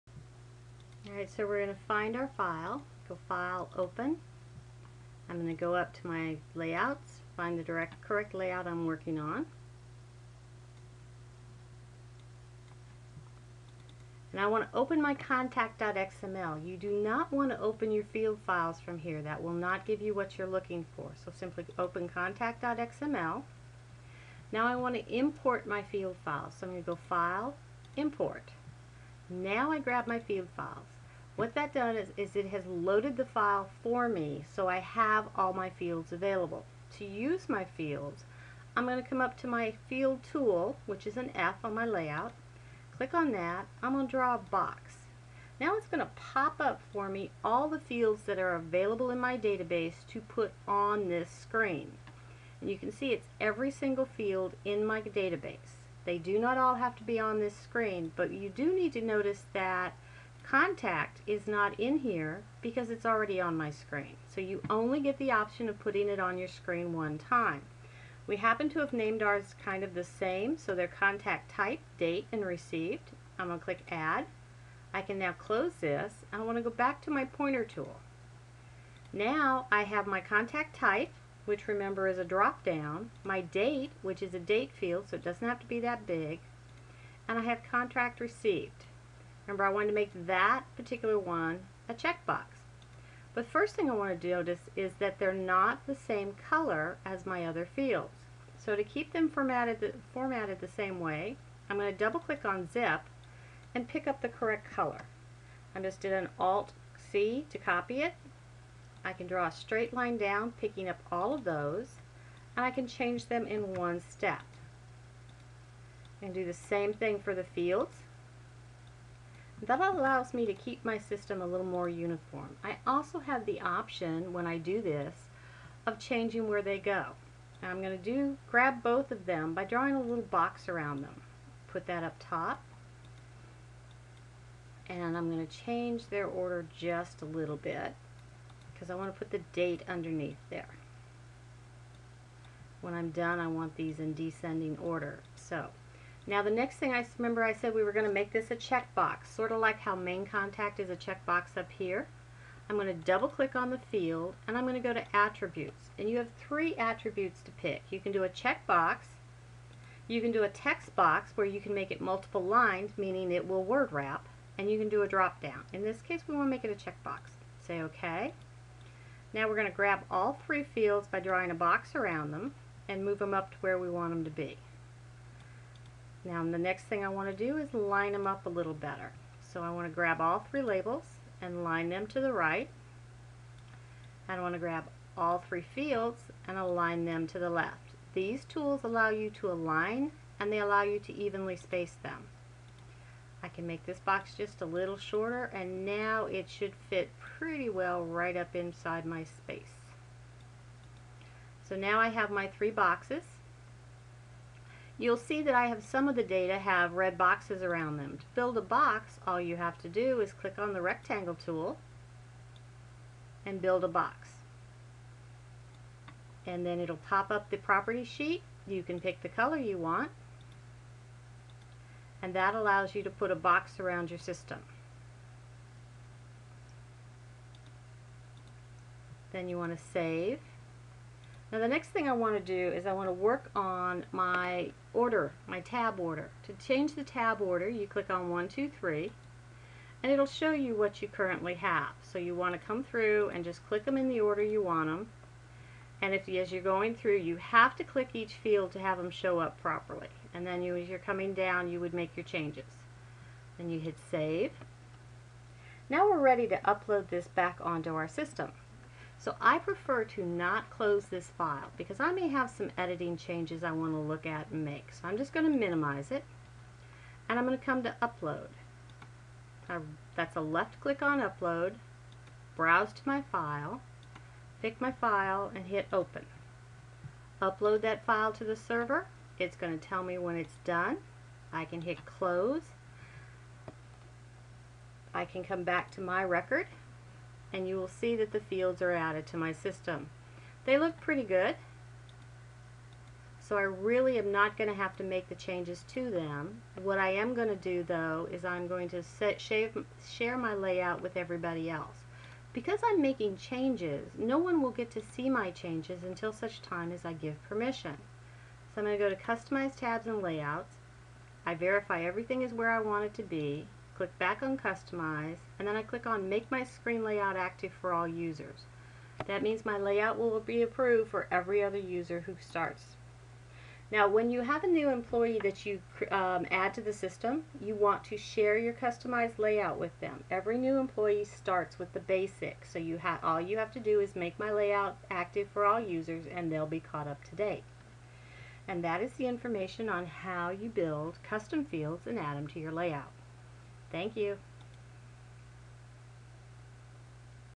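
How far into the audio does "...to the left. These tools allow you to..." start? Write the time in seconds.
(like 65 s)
187 s.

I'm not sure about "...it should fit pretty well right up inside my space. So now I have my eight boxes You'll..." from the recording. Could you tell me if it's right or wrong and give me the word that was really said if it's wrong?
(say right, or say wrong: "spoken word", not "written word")
wrong: "three", not "eight".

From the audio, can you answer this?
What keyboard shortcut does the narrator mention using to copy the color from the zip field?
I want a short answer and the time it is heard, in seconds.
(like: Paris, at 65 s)
Alt C, at 106 s.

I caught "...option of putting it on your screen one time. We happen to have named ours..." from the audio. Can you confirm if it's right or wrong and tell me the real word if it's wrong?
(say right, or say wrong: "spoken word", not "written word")
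right.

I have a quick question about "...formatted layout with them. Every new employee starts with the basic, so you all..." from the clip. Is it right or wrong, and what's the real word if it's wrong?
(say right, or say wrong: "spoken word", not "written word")
wrong: "customized", not "formatted".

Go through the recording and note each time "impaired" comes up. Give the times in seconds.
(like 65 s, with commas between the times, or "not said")
not said.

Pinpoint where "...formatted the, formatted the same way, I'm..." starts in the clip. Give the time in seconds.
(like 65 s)
99 s.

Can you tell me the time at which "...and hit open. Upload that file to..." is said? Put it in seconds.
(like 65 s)
275 s.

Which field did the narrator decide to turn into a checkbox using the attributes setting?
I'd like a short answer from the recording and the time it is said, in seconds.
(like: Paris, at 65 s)
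contract received, at 87 s.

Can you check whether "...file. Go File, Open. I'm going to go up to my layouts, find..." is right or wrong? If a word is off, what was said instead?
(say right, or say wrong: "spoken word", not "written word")
right.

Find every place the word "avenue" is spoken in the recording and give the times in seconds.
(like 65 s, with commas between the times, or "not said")
not said.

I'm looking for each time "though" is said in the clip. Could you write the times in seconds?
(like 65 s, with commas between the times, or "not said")
297 s.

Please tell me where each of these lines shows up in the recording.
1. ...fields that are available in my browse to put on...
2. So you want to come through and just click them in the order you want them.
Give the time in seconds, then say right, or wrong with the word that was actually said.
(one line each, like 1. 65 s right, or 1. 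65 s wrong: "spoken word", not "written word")
1. 47 s wrong: "database", not "browse"
2. 242 s right.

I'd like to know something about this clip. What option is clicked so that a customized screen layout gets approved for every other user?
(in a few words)
Make My Screen Layout Active for All Users.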